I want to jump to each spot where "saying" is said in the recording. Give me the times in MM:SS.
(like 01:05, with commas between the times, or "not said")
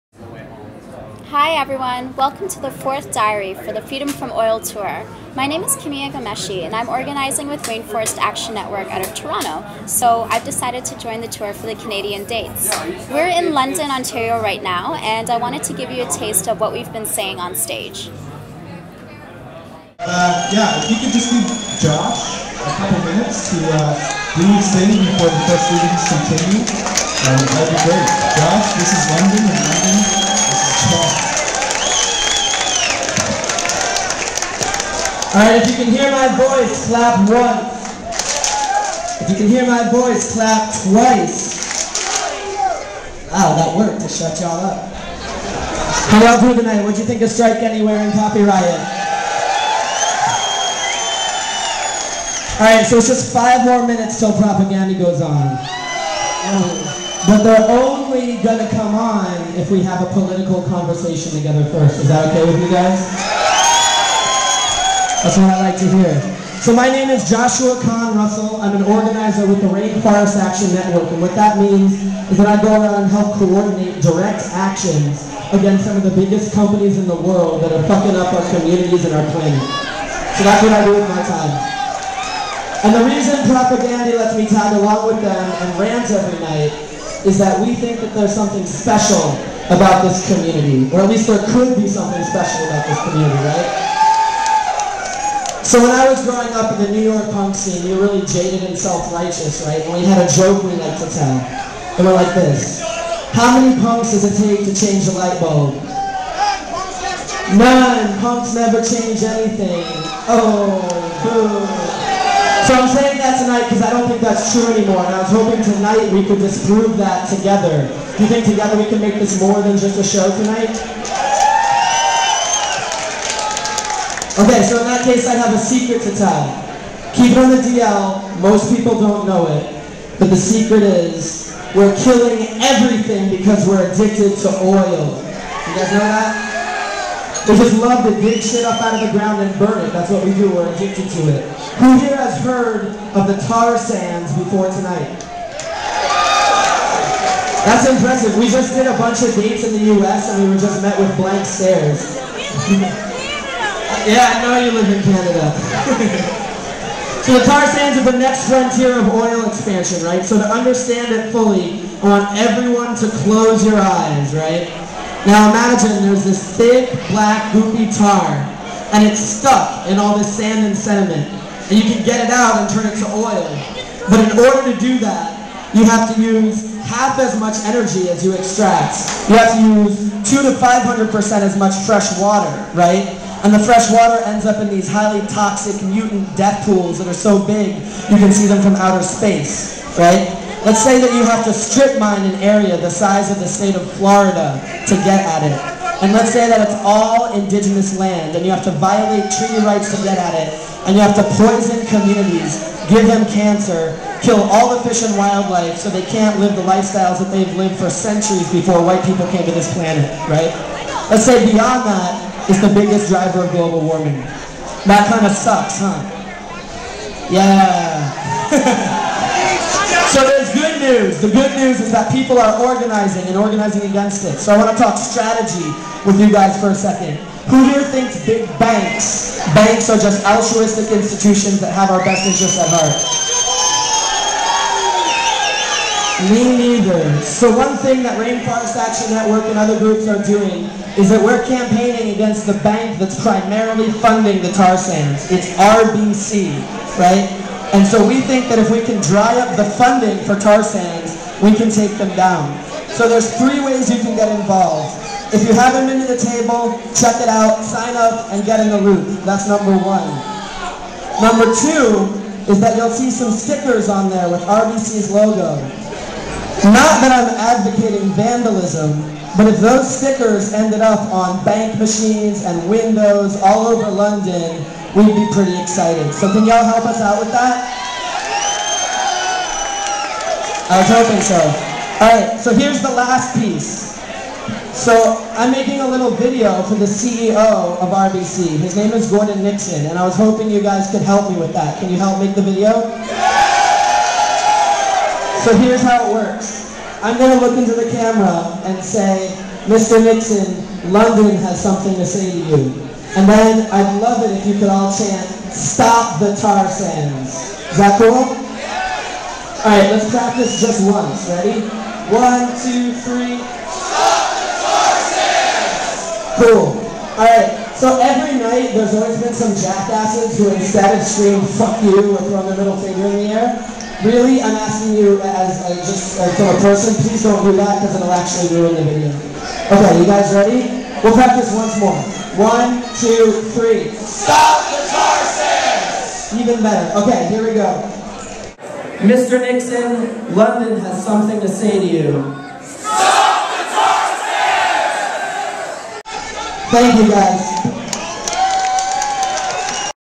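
00:17, 01:52.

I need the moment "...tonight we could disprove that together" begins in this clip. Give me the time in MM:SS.
01:55.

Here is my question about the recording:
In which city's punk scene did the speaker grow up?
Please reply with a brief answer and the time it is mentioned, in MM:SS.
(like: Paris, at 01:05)
New York, at 01:36.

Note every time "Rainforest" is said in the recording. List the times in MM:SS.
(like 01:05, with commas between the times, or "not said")
00:07, 01:09, 03:58.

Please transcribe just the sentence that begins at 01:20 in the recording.
So that's what I do with my time.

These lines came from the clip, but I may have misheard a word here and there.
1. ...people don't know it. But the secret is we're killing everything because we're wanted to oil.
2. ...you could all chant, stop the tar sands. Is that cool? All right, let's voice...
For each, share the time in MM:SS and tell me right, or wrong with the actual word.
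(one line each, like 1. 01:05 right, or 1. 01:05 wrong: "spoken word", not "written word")
1. 02:08 wrong: "addicted", not "wanted"
2. 05:04 wrong: "practice", not "voice".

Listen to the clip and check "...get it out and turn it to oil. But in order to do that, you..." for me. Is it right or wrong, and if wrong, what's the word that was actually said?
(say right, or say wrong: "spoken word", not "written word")
right.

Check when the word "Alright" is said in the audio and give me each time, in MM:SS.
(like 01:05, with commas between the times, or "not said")
00:35, 00:52.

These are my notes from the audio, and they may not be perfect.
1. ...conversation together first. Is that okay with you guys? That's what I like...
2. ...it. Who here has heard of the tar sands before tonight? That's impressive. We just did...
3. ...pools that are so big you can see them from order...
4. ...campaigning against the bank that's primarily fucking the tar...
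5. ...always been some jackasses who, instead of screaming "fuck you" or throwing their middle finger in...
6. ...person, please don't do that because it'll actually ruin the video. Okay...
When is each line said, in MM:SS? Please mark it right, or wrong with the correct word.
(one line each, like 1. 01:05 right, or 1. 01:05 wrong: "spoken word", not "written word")
1. 01:00 right
2. 02:21 right
3. 03:06 wrong: "outer", not "order"
4. 04:01 wrong: "funding", not "fucking"
5. 05:18 right
6. 05:26 right.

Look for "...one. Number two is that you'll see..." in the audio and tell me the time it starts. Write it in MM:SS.
04:19.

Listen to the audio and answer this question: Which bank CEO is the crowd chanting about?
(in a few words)
Gordon Nixon.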